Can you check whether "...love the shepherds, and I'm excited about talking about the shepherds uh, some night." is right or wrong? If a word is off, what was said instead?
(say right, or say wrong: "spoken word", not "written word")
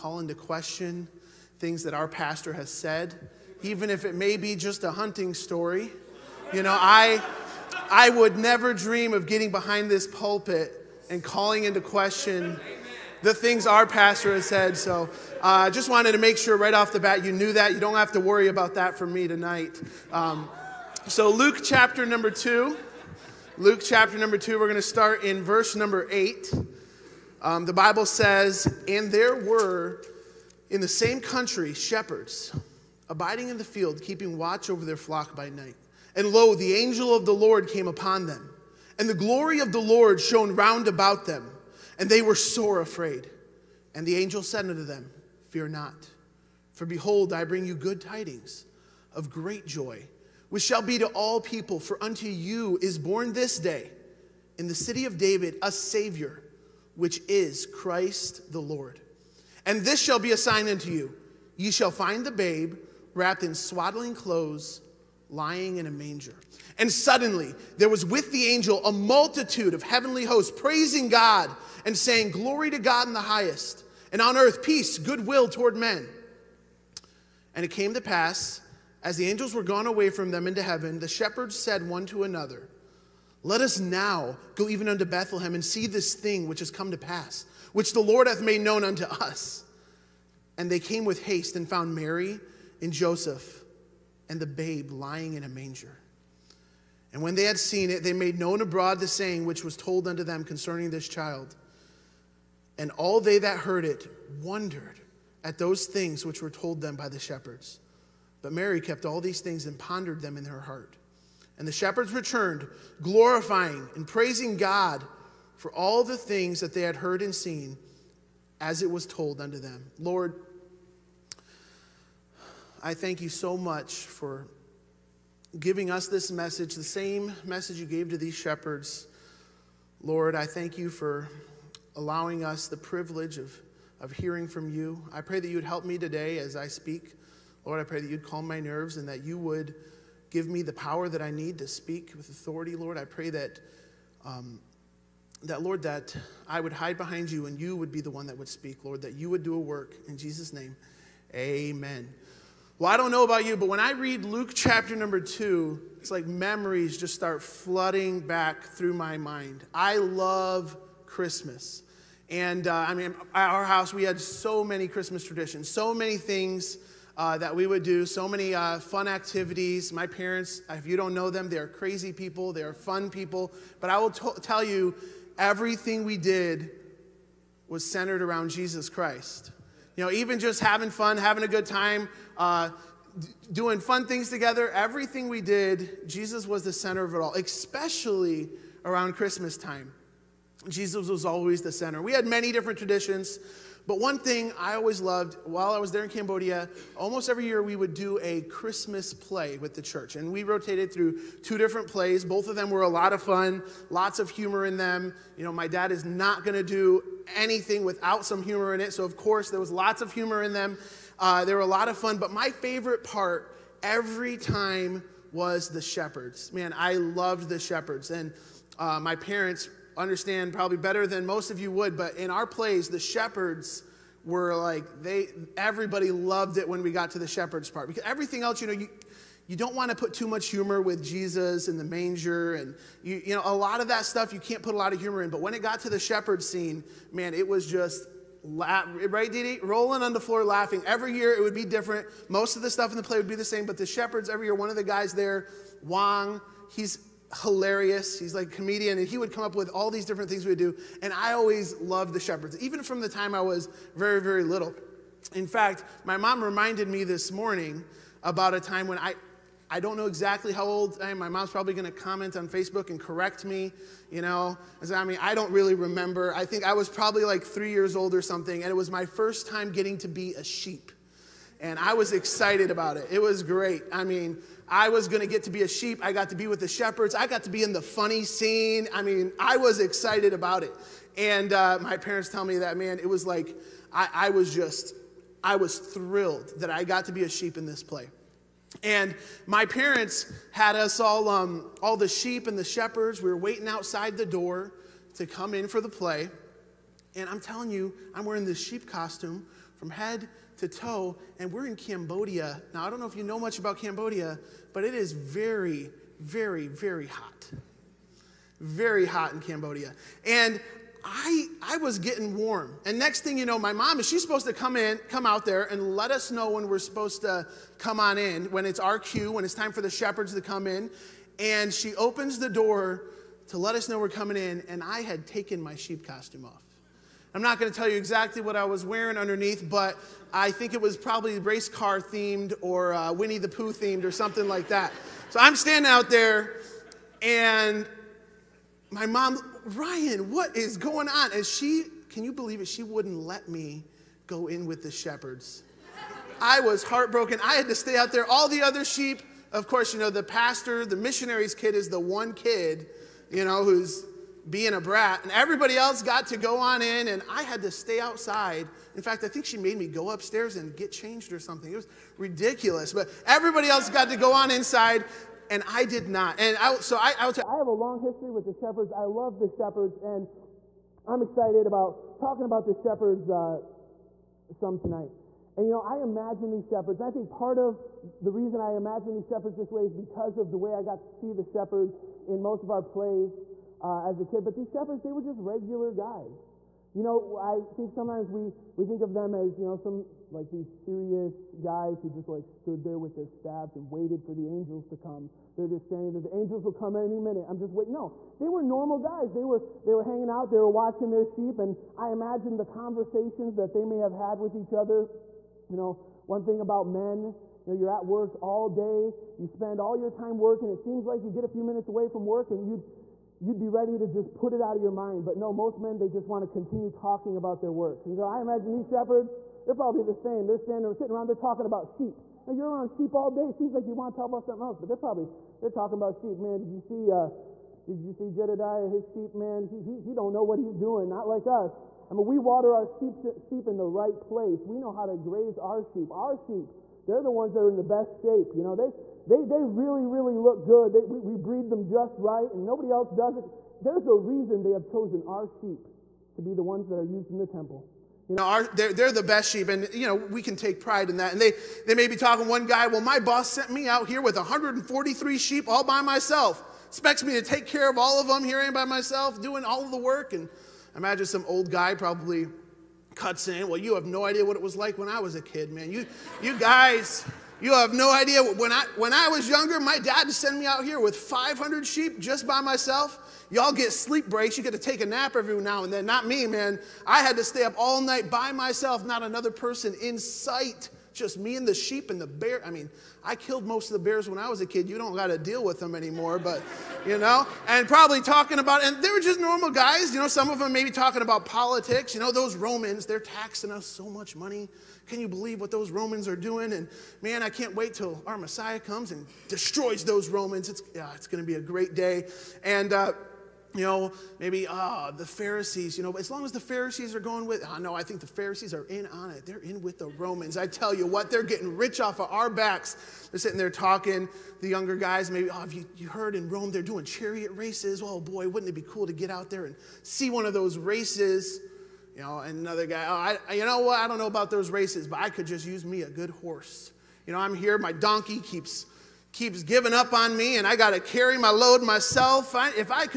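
wrong: "tonight", not "night".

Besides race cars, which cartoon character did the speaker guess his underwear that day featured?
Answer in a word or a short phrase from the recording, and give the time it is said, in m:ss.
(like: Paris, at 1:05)
Winnie the Pooh, at 5:33.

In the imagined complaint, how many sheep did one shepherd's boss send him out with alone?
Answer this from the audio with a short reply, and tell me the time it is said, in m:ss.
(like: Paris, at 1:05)
143, at 7:34.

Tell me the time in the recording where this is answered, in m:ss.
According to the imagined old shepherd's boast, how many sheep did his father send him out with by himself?
7:51.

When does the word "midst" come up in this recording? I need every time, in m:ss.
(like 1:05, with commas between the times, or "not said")
not said.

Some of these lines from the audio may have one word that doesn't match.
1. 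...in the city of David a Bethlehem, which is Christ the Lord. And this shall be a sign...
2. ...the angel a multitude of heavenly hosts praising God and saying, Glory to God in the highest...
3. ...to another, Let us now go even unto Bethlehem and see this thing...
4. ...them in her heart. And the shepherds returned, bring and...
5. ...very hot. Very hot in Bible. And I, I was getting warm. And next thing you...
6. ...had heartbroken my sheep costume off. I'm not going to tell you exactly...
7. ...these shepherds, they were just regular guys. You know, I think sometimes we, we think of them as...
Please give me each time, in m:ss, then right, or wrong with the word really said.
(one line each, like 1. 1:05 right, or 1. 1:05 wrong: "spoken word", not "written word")
1. 0:54 wrong: "Savior", not "Bethlehem"
2. 1:08 right
3. 1:22 right
4. 1:50 wrong: "glorifying", not "bring"
5. 5:06 wrong: "Cambodia", not "Bible"
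6. 5:25 wrong: "taken", not "heartbroken"
7. 6:24 right.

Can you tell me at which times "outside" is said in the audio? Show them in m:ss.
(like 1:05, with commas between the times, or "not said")
4:53, 5:57.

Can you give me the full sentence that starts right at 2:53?
But I will t- tell you, everything we did was centered around Jesus Christ.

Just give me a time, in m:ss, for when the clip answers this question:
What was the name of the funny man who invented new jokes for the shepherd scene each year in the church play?
4:05.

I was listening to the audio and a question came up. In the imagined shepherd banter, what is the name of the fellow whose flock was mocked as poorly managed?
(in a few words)
Jedediah.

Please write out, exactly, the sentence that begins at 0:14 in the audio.
So uh, I uh, just wanted to make sure right off the bat you knew that.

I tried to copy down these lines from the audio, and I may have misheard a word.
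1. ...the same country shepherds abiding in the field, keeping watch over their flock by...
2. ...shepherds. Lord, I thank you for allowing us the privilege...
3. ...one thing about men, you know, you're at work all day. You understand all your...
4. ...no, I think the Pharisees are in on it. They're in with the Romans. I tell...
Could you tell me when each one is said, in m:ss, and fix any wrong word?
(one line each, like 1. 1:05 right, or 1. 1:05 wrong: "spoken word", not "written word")
1. 0:30 right
2. 2:08 right
3. 6:46 wrong: "spend", not "understand"
4. 8:27 right.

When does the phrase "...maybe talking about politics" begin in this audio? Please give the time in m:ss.
8:10.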